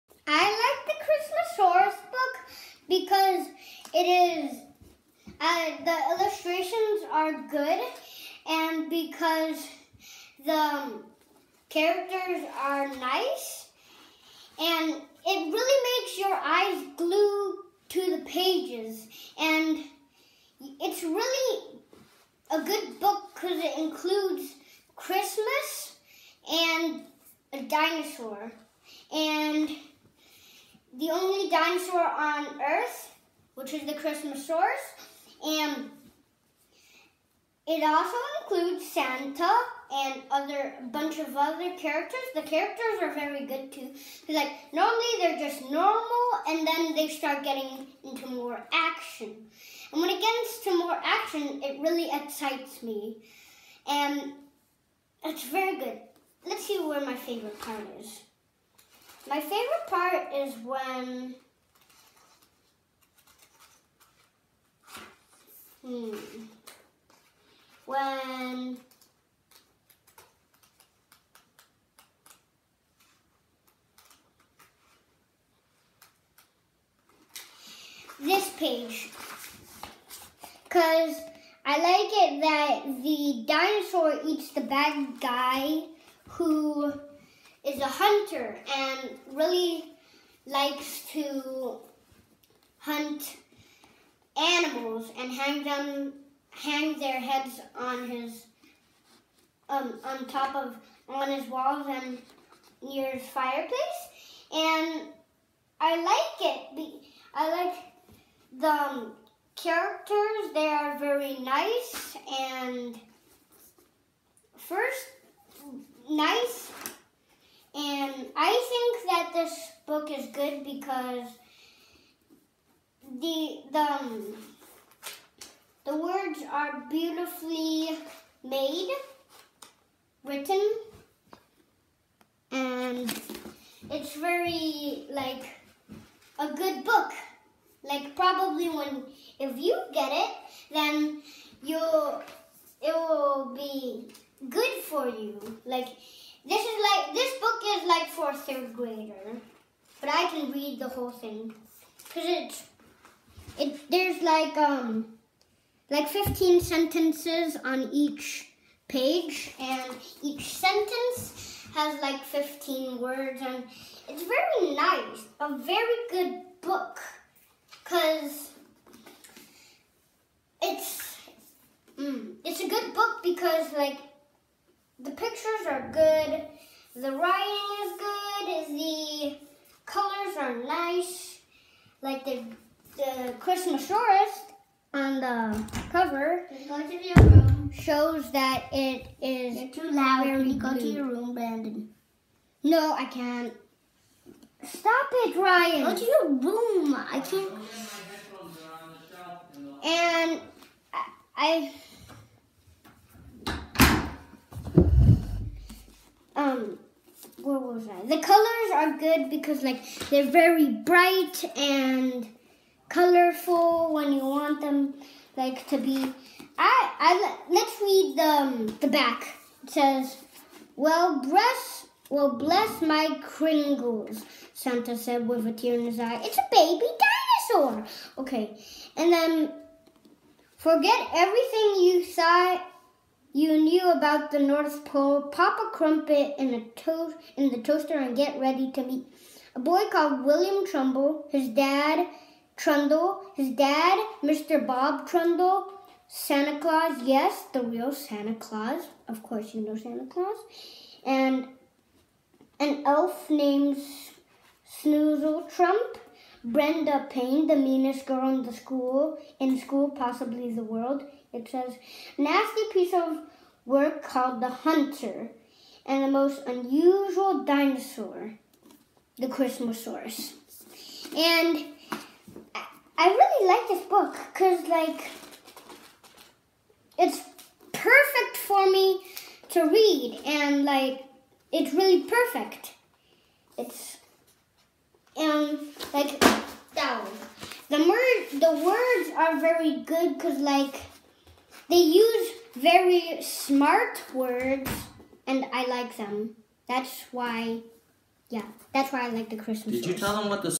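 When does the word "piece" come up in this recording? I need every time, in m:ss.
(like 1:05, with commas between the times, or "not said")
4:22.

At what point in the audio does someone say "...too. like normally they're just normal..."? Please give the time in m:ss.
0:43.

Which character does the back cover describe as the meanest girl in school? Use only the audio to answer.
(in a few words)
Brenda Payne.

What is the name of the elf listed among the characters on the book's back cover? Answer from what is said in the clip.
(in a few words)
Snoozle Trump.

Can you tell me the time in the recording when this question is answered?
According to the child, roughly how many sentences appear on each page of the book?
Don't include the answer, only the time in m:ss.
2:36.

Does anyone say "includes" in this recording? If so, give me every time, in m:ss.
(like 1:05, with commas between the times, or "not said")
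0:23, 0:38.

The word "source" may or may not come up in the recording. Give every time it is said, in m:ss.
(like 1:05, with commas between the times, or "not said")
0:34.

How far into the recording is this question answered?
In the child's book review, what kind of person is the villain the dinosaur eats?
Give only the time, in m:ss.
1:27.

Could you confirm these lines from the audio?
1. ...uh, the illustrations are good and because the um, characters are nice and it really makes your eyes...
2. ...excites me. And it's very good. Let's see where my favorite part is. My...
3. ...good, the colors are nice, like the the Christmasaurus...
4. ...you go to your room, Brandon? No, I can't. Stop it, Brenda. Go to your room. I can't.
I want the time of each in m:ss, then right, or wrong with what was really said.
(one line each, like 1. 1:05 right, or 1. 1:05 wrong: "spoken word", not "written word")
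1. 0:05 right
2. 0:52 right
3. 2:57 right
4. 3:10 wrong: "Ryan", not "Brenda".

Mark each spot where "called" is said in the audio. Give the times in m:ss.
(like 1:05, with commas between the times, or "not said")
3:59, 4:24.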